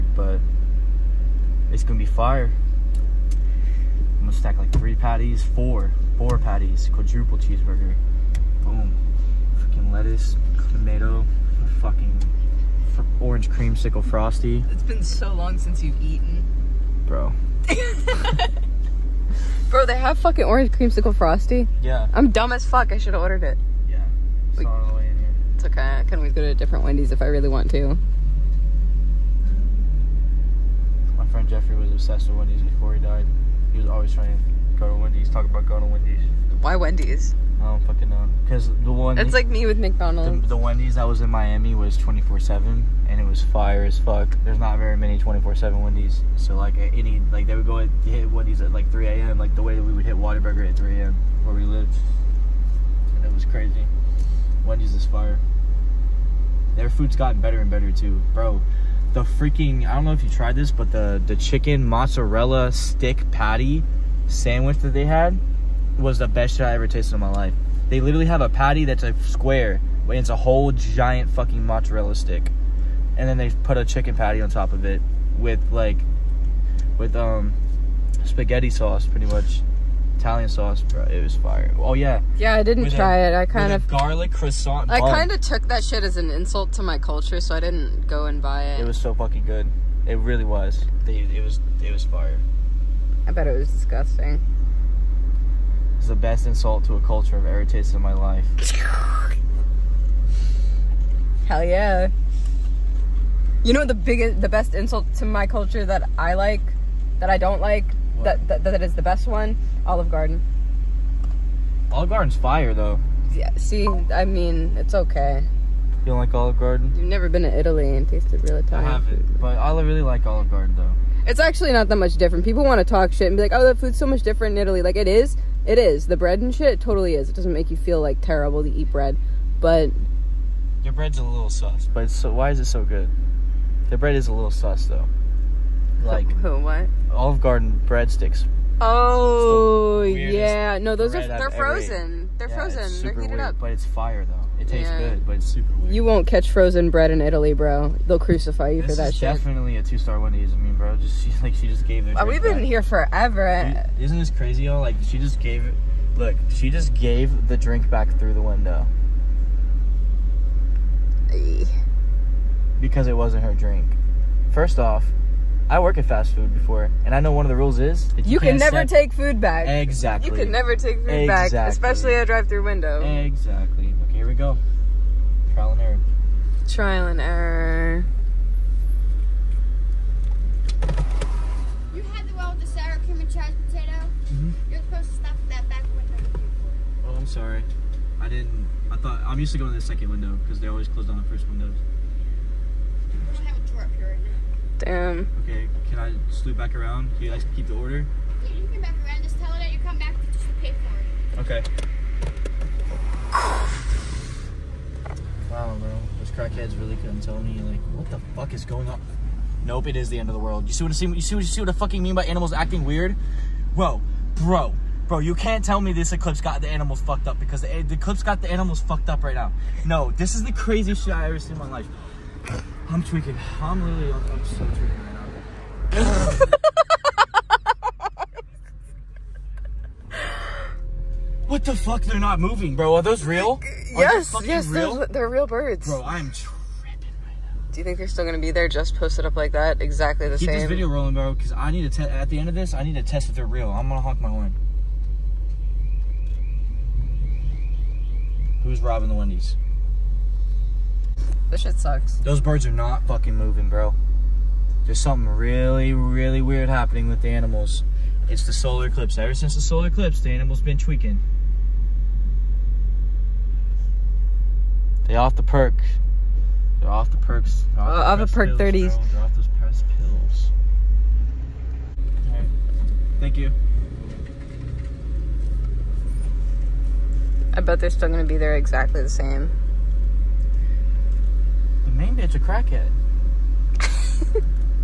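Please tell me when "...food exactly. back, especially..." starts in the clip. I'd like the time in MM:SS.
02:50.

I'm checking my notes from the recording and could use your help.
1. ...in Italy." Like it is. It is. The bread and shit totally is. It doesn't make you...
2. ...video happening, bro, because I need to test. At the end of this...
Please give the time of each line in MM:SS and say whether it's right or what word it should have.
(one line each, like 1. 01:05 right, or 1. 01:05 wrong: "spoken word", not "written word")
1. 02:04 right
2. 04:00 wrong: "rolling", not "happening".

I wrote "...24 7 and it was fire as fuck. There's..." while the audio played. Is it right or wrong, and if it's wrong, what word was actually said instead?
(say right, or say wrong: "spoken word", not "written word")
right.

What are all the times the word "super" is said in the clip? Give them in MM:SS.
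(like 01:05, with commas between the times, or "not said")
02:25.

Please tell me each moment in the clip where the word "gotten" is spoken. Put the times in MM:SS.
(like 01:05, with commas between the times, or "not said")
00:57.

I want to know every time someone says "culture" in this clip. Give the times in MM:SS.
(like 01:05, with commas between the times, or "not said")
01:26, 01:36, 01:45.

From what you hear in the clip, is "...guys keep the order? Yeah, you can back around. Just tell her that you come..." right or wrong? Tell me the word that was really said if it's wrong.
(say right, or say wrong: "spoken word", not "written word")
right.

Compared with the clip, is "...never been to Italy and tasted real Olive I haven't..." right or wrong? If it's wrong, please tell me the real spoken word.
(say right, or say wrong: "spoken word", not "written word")
wrong: "Italian", not "Olive".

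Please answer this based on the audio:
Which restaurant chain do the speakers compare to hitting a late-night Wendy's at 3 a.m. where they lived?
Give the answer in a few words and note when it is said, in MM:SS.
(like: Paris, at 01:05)
Whataburger, at 00:50.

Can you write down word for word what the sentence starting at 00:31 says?
friend Jeffrey was obsessed with Wendy's before he died.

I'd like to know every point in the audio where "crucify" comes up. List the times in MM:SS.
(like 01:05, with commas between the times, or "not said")
02:28.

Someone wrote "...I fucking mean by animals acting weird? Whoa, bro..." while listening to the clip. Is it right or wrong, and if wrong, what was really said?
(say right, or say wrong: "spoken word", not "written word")
right.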